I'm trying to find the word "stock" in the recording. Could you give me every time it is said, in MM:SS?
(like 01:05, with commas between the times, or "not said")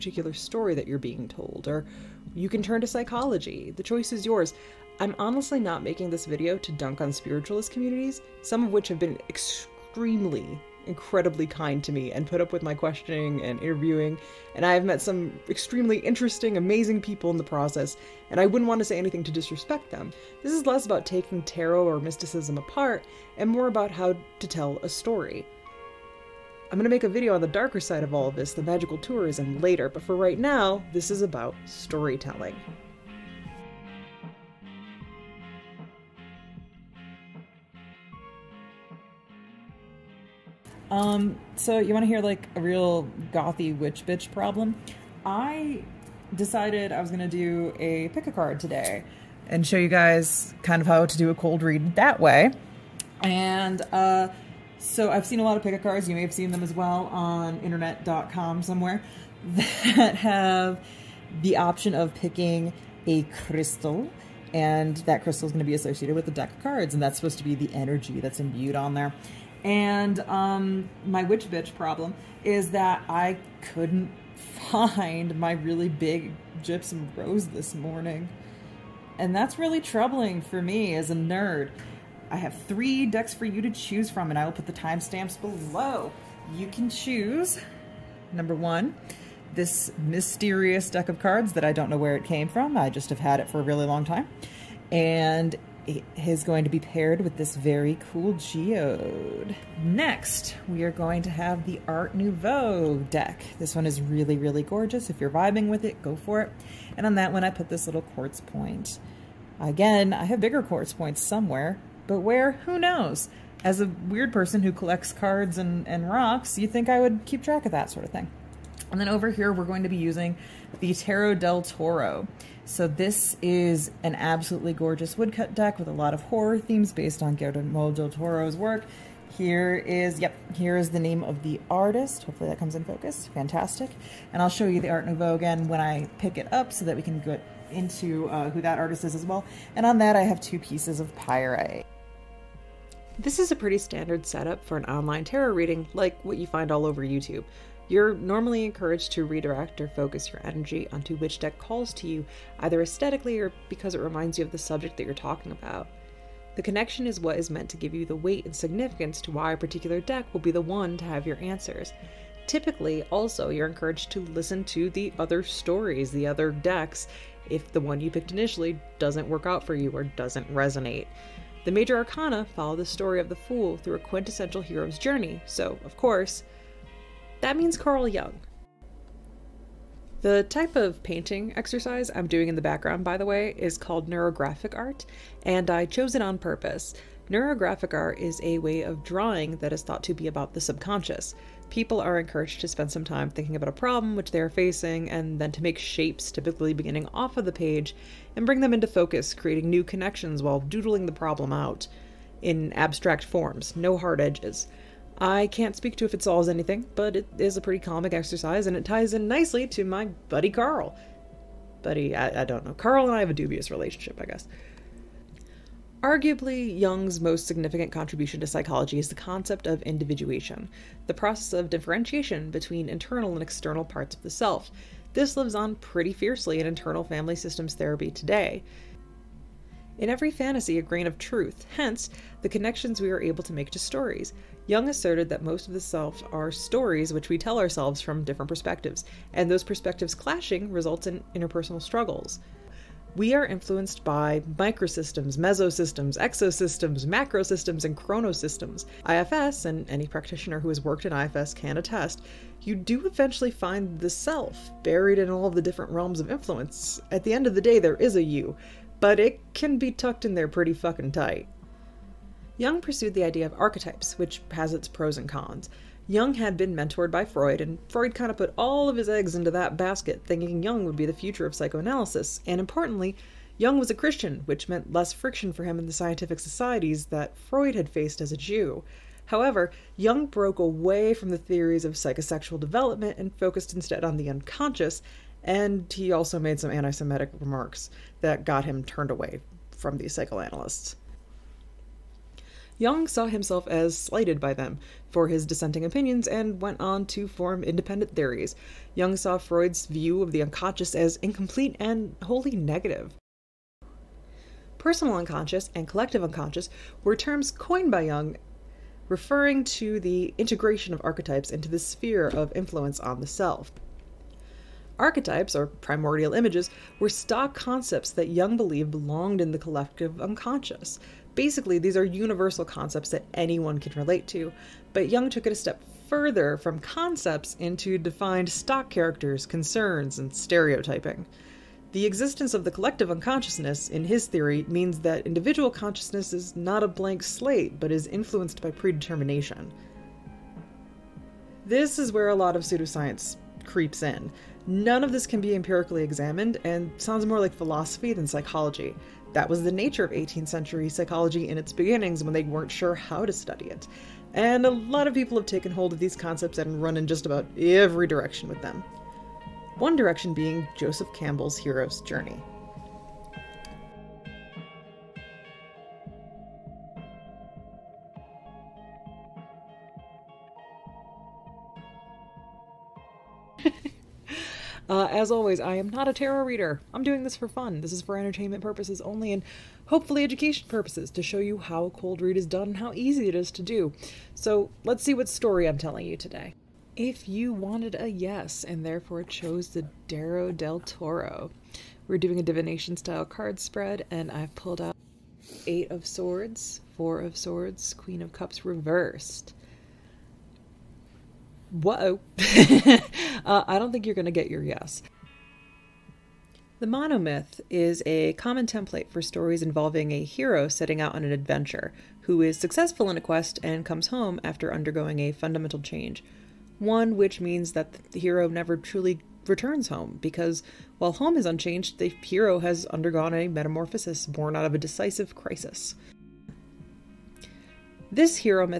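05:17, 05:28.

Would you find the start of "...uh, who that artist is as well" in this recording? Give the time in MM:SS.
02:18.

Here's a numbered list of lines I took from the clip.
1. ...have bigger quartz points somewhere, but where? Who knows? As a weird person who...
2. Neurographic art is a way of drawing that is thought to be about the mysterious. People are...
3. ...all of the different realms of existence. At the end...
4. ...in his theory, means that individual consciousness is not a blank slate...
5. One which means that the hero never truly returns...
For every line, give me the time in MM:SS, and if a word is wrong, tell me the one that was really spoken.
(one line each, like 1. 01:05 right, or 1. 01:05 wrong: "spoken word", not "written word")
1. 01:50 right
2. 03:07 wrong: "subconscious", not "mysterious"
3. 04:15 wrong: "influence", not "existence"
4. 05:33 right
5. 06:56 right.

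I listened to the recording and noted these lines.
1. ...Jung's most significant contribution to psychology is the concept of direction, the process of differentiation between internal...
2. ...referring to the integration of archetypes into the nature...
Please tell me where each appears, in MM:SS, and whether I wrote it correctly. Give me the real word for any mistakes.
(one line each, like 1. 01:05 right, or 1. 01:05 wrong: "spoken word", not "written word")
1. 03:36 wrong: "individuation", not "direction"
2. 05:09 wrong: "sphere", not "nature".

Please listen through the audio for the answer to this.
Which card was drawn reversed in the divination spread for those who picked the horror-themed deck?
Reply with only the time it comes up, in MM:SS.
06:37.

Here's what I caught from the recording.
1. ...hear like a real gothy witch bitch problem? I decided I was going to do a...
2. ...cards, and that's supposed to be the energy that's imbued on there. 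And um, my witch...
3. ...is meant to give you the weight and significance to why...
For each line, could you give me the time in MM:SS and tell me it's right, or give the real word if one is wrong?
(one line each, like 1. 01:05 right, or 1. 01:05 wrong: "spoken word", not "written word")
1. 00:42 right
2. 01:06 right
3. 02:37 right.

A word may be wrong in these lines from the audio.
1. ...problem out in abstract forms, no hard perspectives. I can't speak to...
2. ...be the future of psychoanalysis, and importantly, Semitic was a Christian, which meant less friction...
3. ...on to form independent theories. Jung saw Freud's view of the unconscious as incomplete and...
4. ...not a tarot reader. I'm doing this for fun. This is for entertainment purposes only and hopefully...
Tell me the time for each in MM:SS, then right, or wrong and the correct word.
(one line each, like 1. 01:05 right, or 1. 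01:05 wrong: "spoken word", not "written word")
1. 03:21 wrong: "edges", not "perspectives"
2. 04:30 wrong: "Jung", not "Semitic"
3. 04:56 right
4. 06:15 right.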